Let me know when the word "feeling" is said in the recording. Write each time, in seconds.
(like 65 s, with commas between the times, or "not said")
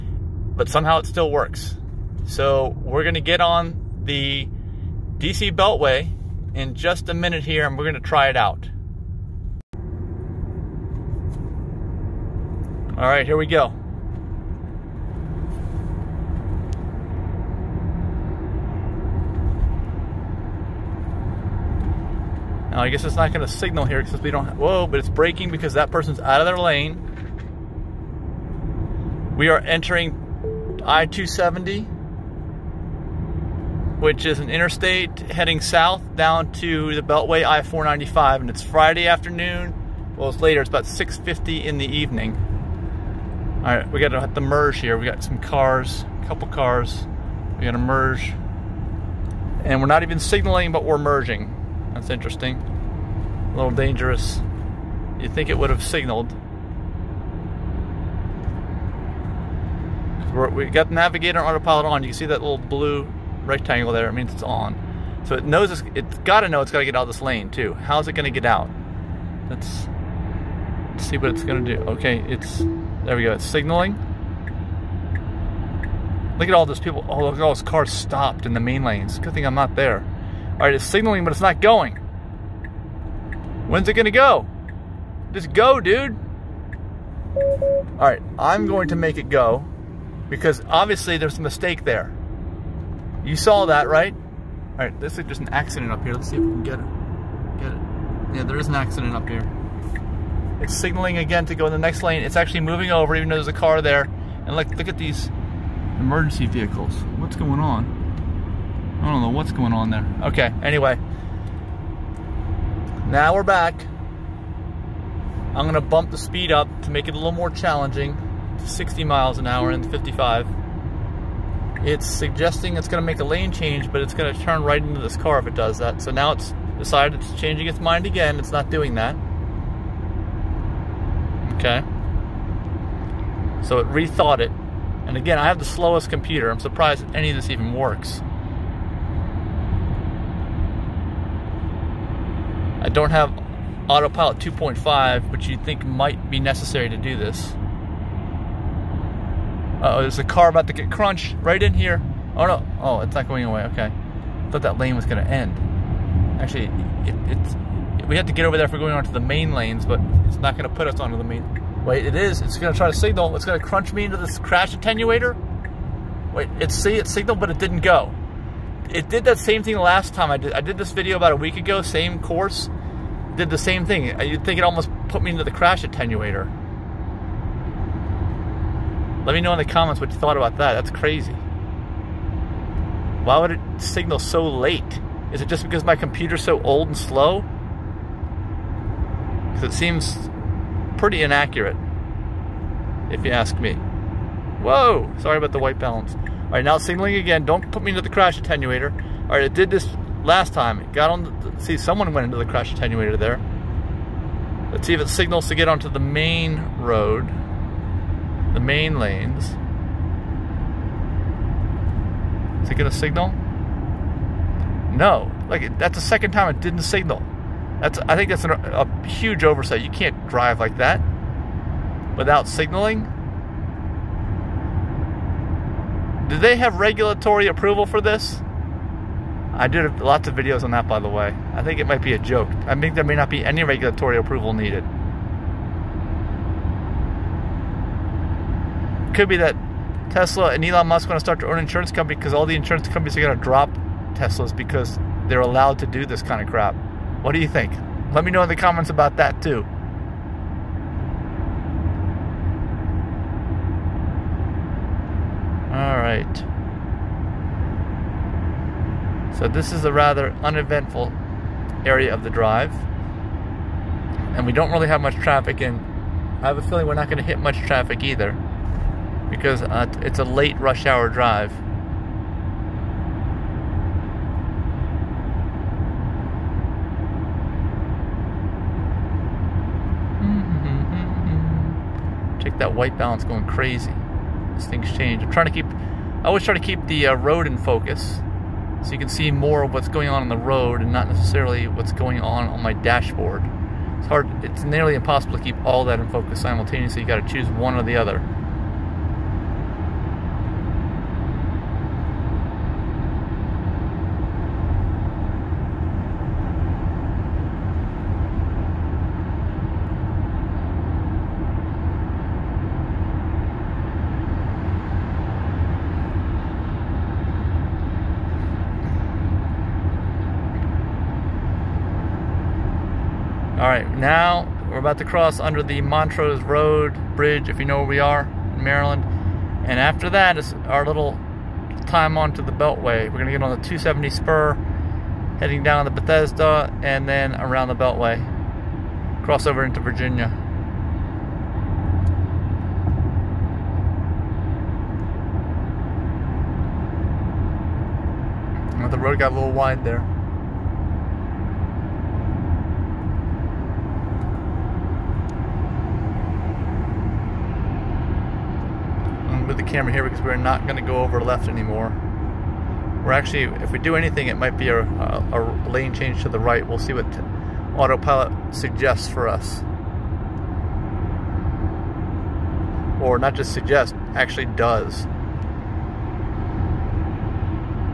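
266 s.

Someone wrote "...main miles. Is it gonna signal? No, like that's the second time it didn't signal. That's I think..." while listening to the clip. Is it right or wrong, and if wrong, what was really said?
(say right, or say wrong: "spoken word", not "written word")
wrong: "lanes", not "miles".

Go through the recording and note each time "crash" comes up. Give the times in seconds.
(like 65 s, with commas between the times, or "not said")
164 s, 175 s, 198 s, 202 s.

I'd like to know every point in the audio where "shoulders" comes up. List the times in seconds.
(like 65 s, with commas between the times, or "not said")
not said.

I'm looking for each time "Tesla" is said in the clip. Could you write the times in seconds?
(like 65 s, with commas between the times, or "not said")
240 s, 244 s.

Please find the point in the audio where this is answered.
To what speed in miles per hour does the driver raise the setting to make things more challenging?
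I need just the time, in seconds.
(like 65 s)
118 s.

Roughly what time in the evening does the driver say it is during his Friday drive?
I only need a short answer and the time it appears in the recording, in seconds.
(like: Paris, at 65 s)
6:50, at 40 s.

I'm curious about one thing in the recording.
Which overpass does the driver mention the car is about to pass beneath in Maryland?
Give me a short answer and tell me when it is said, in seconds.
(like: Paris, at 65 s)
Montrose Road Bridge, at 325 s.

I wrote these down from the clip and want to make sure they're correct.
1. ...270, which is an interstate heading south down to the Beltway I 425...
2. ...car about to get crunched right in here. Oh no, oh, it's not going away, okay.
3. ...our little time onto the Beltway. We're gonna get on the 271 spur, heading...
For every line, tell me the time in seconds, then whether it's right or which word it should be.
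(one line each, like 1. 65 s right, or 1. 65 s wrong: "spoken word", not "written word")
1. 31 s wrong: "495", not "425"
2. 150 s right
3. 330 s wrong: "270", not "271".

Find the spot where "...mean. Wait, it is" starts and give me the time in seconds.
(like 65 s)
161 s.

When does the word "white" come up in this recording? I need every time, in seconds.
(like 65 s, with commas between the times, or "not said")
195 s, 282 s.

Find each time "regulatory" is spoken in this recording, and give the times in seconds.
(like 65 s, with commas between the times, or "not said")
226 s, 233 s.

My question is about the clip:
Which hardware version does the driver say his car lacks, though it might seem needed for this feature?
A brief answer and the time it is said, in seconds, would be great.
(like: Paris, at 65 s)
Autopilot 2.5, at 143 s.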